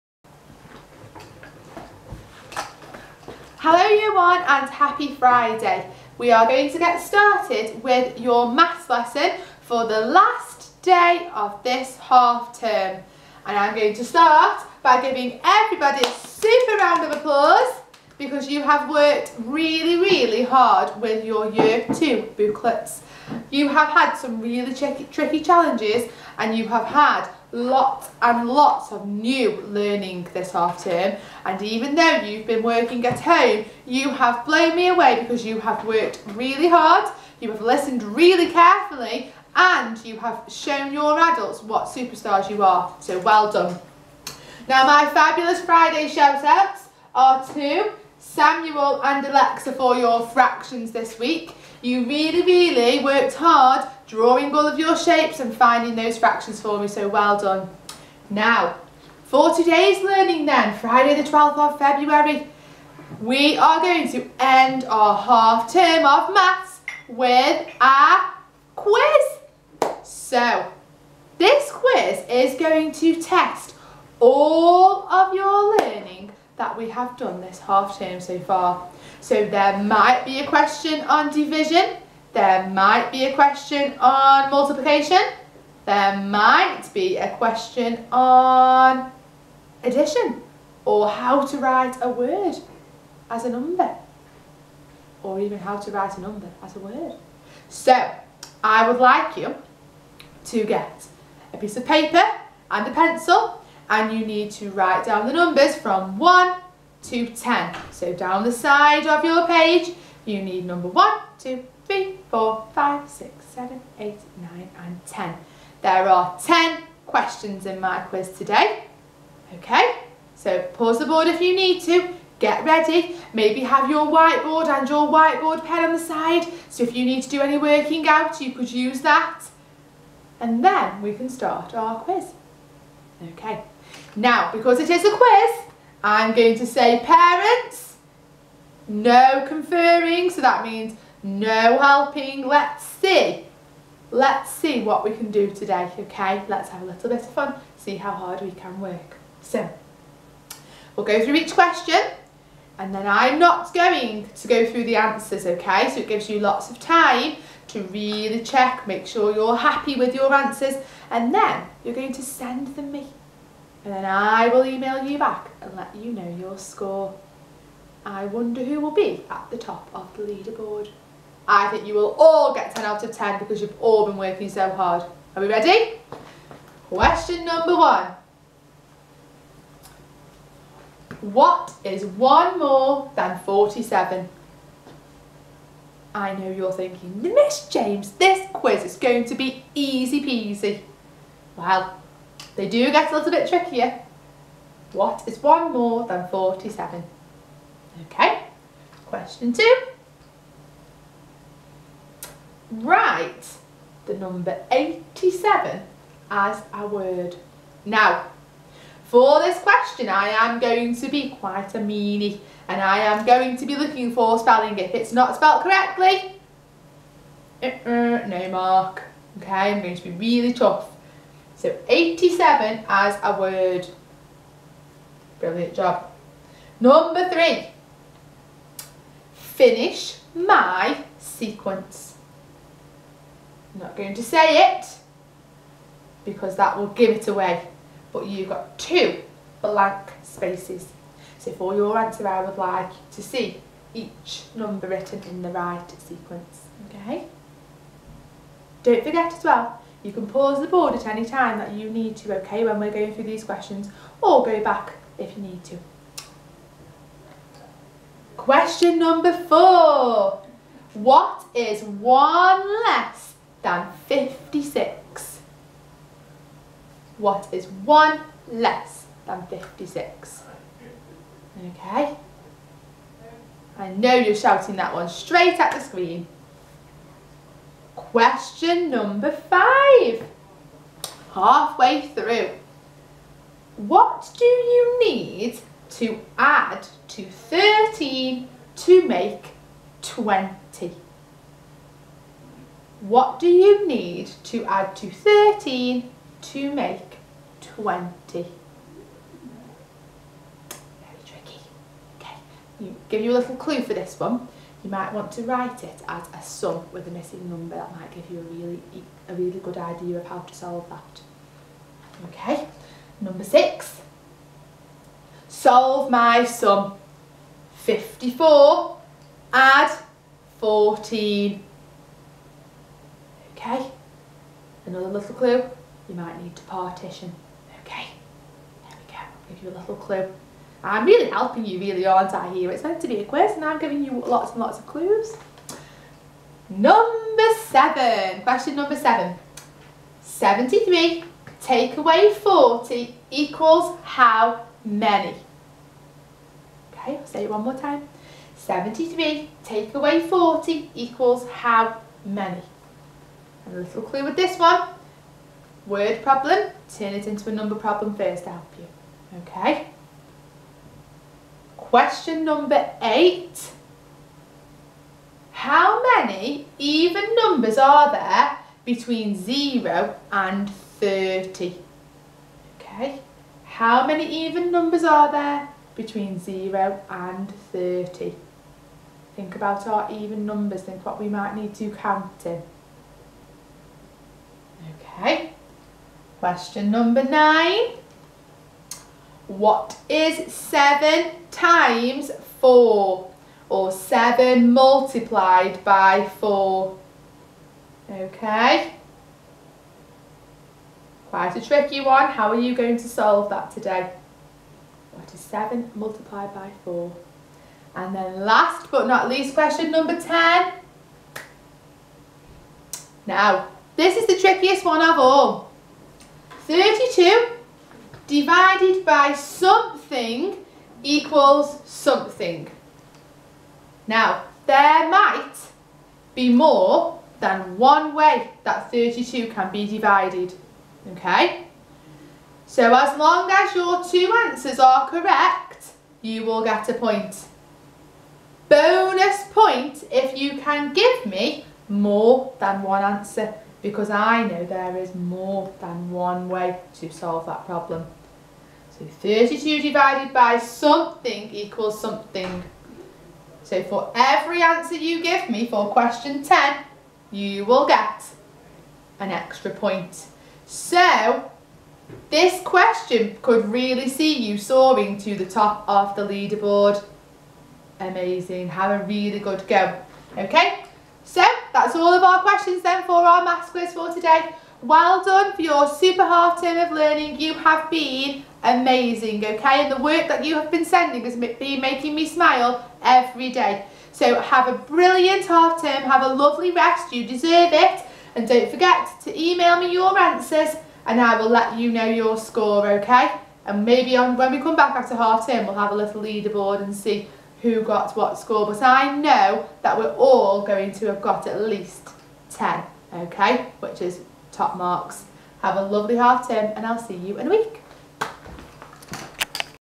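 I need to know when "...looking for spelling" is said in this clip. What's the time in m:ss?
3:33.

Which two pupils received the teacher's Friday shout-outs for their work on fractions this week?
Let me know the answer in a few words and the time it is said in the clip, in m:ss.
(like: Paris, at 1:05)
Samuel and Alexa, at 0:48.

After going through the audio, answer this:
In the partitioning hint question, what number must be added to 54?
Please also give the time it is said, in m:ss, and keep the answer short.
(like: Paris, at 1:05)
14, at 5:20.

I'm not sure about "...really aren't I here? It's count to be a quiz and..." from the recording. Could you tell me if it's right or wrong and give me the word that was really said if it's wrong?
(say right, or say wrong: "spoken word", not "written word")
wrong: "meant", not "count".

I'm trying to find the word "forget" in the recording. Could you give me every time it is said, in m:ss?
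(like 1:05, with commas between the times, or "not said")
4:09, 8:08.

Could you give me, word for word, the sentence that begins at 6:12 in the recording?
Okay, how many even numbers are there between 0 and 30?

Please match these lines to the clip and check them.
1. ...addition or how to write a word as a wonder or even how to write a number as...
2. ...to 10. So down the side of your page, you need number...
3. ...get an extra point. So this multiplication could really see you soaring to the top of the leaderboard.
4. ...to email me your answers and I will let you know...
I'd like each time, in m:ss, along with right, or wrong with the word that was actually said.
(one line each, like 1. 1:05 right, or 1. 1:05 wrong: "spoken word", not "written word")
1. 1:29 wrong: "number", not "wonder"
2. 1:47 right
3. 7:37 wrong: "question", not "multiplication"
4. 8:09 right.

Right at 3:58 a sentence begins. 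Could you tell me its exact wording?
But you've got two blank spaces.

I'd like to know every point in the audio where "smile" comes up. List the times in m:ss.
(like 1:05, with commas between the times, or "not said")
8:02.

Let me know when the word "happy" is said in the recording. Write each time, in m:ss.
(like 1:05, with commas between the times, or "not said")
0:04, 2:39.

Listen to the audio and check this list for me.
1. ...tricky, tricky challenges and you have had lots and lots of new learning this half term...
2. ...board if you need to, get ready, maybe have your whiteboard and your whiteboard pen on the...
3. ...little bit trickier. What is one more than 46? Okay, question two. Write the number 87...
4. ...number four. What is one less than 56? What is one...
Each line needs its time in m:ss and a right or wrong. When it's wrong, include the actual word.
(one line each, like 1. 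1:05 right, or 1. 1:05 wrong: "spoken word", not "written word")
1. 0:24 right
2. 2:01 right
3. 3:13 wrong: "47", not "46"
4. 4:18 right.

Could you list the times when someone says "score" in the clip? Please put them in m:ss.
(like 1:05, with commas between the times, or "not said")
2:46, 8:12, 8:18.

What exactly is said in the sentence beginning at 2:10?
And then we can start our quiz.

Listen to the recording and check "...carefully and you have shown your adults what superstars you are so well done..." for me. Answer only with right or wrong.
right.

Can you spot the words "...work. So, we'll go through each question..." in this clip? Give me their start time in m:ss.
2:28.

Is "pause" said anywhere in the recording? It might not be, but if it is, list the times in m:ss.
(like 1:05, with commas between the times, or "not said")
2:00, 4:10.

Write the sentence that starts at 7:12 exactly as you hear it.
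So as long as your two answers are correct, you will get a point.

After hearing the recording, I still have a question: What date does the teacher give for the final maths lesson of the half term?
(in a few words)
Friday the 12th of February.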